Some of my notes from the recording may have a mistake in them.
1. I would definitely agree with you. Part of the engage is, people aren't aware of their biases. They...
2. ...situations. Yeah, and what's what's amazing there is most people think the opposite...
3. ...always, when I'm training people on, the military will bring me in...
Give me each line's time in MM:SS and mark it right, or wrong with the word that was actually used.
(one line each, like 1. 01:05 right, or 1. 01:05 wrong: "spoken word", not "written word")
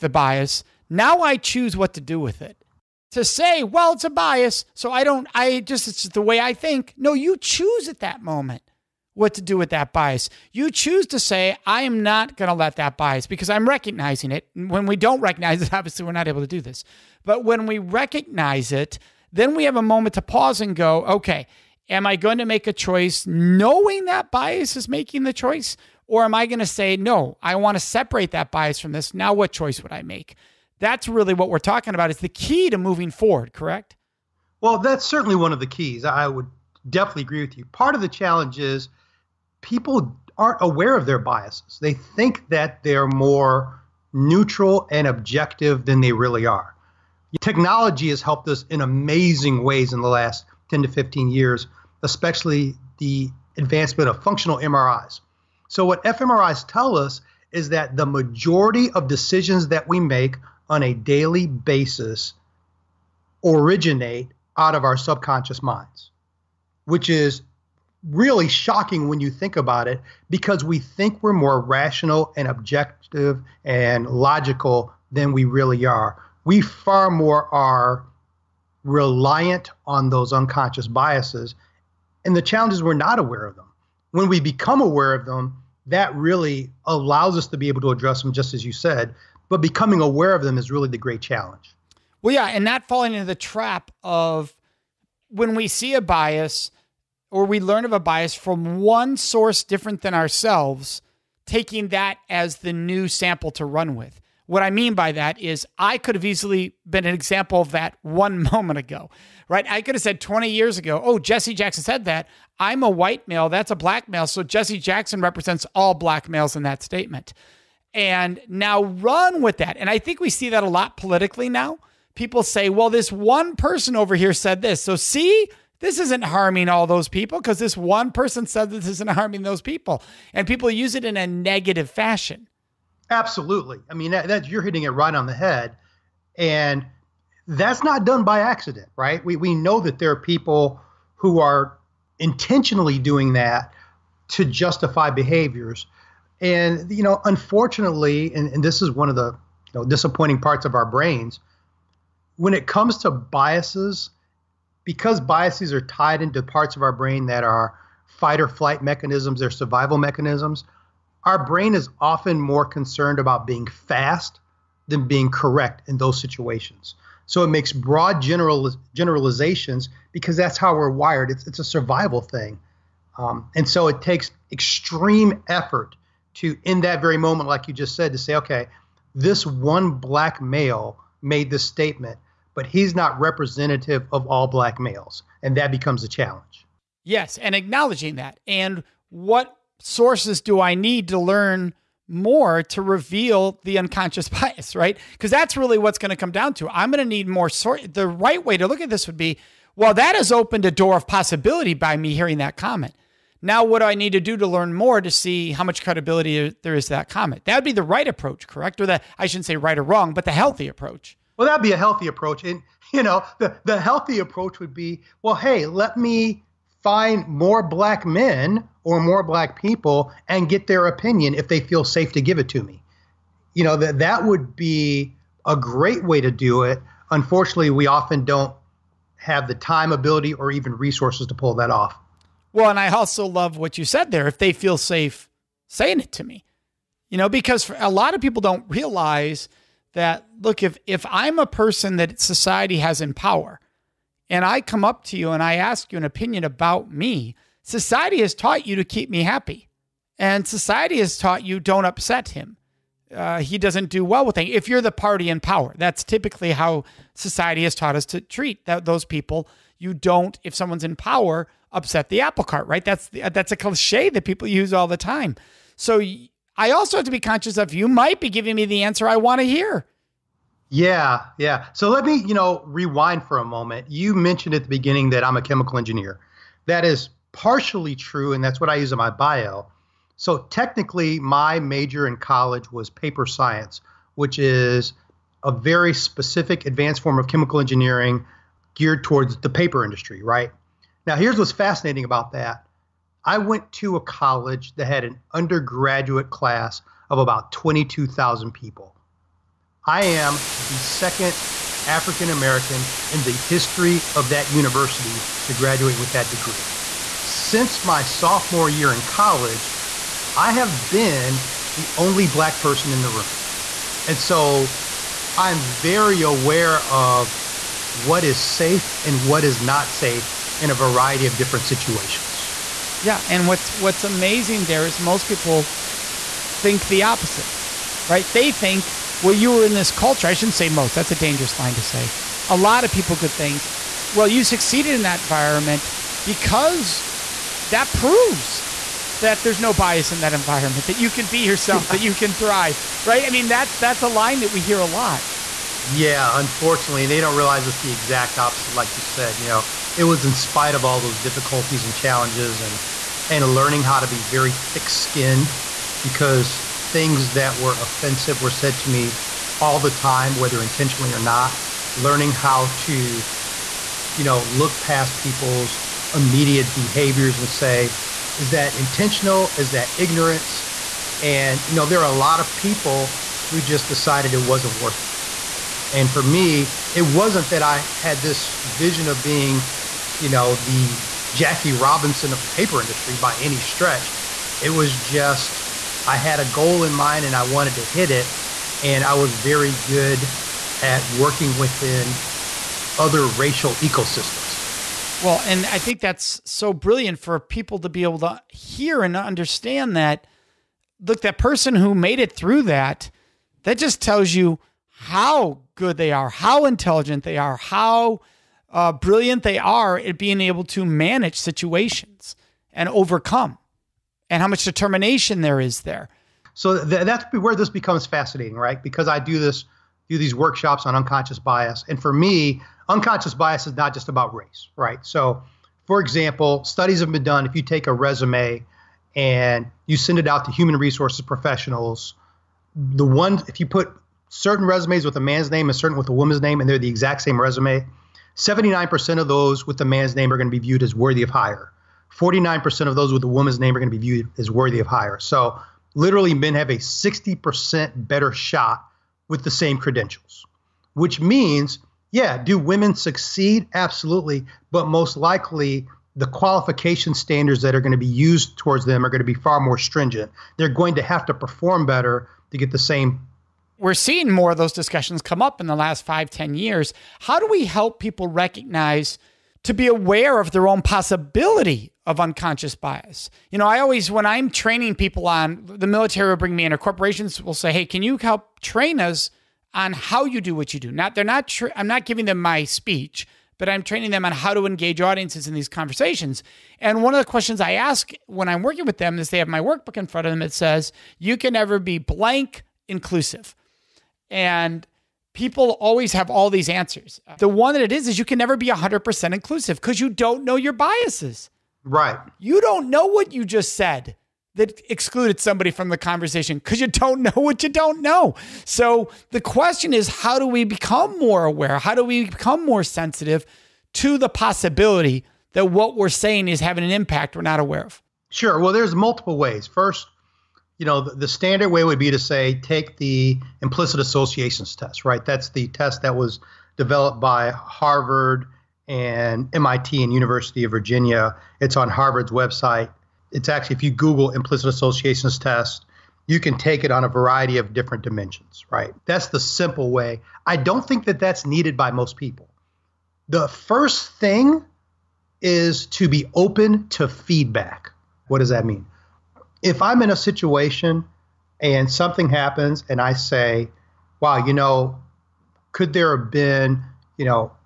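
1. 00:36 wrong: "challenge", not "engage"
2. 05:21 right
3. 07:53 right.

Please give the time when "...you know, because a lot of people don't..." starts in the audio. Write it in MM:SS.
03:57.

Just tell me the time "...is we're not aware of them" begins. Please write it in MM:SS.
01:22.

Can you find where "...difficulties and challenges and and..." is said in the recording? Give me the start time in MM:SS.
05:51.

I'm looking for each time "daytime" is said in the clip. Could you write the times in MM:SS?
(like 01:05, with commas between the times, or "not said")
not said.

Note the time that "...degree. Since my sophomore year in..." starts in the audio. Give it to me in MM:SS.
05:06.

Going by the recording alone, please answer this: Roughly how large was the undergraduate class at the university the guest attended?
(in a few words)
22,000.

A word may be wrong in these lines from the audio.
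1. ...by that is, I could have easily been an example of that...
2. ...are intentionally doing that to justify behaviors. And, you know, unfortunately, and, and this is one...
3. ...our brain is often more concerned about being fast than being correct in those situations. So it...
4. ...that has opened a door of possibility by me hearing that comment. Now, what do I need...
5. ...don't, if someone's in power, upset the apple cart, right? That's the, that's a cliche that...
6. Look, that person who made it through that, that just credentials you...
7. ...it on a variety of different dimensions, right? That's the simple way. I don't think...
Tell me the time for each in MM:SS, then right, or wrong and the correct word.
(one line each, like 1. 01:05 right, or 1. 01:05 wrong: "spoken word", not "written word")
1. 01:44 right
2. 02:21 right
3. 02:41 right
4. 03:19 right
5. 04:19 right
6. 06:40 wrong: "tells", not "credentials"
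7. 08:56 right.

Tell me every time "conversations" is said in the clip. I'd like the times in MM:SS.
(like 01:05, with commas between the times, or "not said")
08:05, 08:25.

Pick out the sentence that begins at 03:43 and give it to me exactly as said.
You know, that that would be a great way to do it.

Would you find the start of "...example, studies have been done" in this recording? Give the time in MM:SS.
07:06.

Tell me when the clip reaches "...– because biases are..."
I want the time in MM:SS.
02:34.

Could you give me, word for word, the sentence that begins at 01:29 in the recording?
But becoming aware of them is really the great challenge.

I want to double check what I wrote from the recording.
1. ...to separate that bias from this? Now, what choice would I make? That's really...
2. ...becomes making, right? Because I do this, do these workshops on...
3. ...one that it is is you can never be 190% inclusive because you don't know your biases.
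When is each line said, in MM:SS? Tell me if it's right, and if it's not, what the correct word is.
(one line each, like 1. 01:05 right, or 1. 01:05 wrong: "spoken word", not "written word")
1. 00:27 right
2. 06:57 wrong: "fascinating", not "making"
3. 08:17 wrong: "100", not "190".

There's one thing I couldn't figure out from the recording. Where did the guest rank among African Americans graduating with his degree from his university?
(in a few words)
second.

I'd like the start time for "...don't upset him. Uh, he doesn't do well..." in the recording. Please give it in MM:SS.
04:11.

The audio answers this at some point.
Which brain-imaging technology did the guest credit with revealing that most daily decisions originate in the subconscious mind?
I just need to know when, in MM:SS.
00:54.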